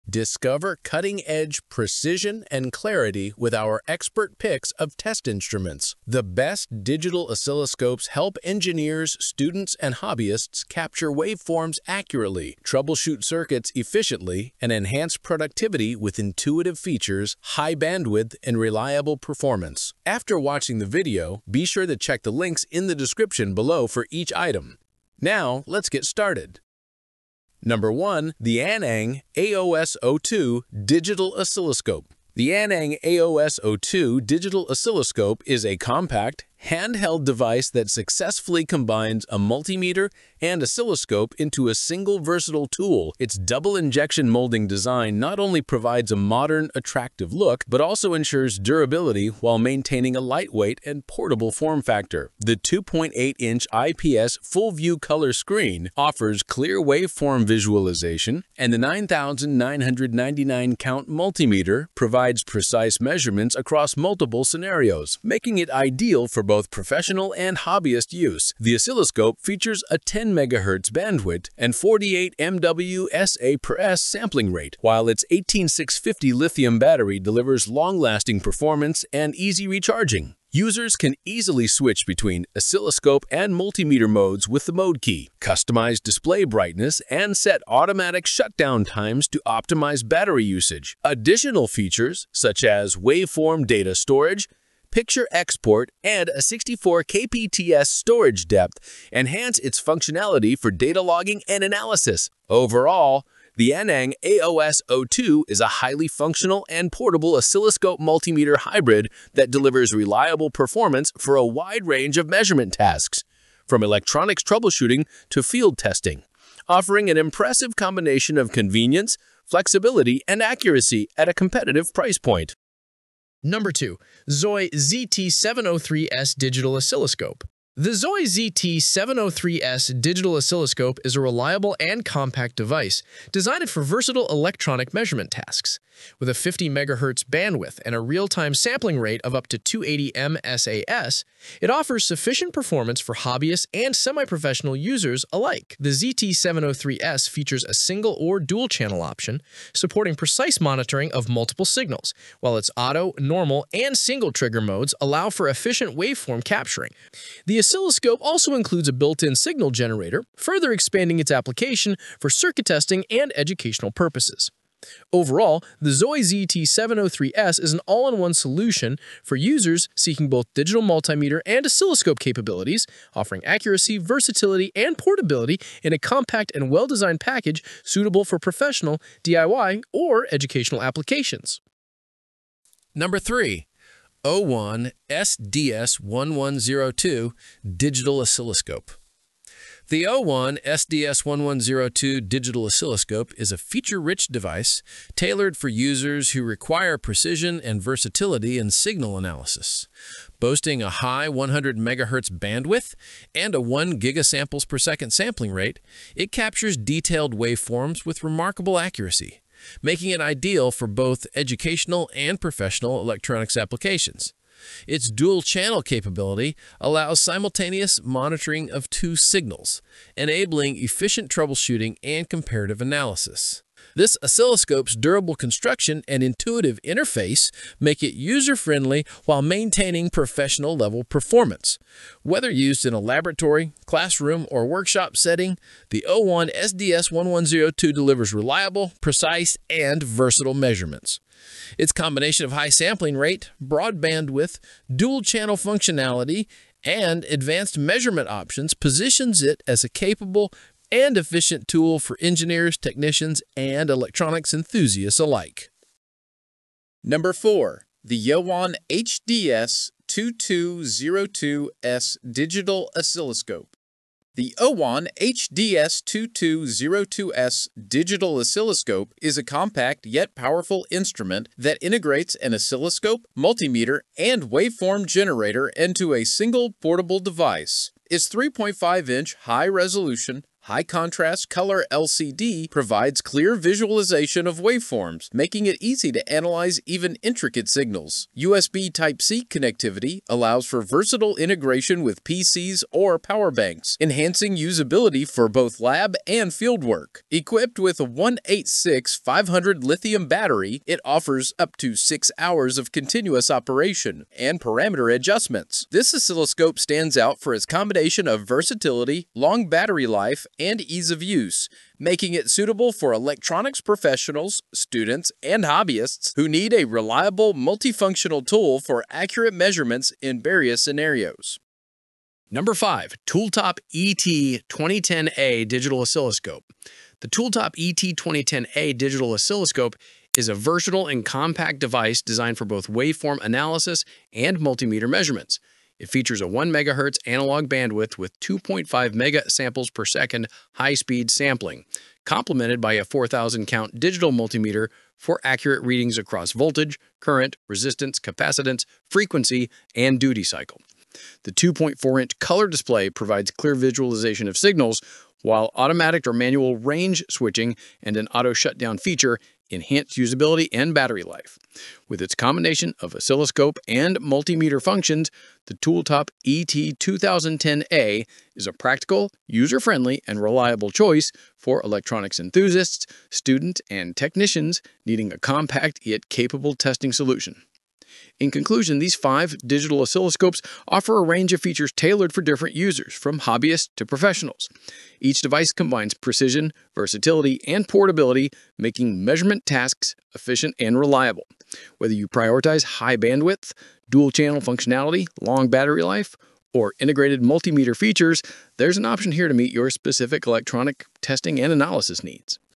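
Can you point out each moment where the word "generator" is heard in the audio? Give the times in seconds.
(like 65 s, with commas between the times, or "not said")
159 s, 275 s.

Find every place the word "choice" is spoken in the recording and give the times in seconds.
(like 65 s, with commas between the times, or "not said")
370 s.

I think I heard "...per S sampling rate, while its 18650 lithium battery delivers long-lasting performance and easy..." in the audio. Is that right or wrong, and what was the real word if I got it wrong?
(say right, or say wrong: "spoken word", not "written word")
right.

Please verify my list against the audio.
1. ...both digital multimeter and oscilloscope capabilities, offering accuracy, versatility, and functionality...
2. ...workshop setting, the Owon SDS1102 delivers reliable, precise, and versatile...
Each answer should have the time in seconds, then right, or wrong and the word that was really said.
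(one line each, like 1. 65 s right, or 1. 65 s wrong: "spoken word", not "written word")
1. 170 s wrong: "portability", not "functionality"
2. 234 s right.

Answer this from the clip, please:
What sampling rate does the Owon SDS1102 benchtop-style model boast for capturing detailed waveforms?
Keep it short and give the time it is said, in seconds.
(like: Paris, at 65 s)
1 gigasamples per second, at 203 s.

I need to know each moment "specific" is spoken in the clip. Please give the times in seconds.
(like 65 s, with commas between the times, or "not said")
399 s.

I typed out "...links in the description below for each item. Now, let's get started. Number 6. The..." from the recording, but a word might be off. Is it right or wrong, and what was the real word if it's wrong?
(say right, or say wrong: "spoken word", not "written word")
wrong: "1", not "6".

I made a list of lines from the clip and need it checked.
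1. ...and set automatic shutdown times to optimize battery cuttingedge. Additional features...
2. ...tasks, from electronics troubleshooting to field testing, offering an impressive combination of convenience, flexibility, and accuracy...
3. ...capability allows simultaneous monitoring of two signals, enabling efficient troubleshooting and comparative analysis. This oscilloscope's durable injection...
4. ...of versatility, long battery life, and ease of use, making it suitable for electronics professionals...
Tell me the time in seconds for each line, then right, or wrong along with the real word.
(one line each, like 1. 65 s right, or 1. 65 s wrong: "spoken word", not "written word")
1. 87 s wrong: "usage", not "cuttingedge"
2. 112 s right
3. 215 s wrong: "construction", not "injection"
4. 308 s right.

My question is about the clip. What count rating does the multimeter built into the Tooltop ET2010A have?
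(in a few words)
4,000 count.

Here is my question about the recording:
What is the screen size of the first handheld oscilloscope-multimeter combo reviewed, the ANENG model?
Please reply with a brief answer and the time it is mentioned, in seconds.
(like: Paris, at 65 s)
2.8-inch, at 52 s.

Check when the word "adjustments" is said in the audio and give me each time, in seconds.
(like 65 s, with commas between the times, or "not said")
305 s.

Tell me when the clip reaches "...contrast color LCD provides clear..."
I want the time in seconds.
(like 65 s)
280 s.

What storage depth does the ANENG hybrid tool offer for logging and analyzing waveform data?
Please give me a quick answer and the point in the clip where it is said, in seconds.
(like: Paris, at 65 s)
64 kpts, at 96 s.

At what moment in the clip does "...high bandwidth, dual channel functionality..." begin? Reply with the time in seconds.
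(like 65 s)
392 s.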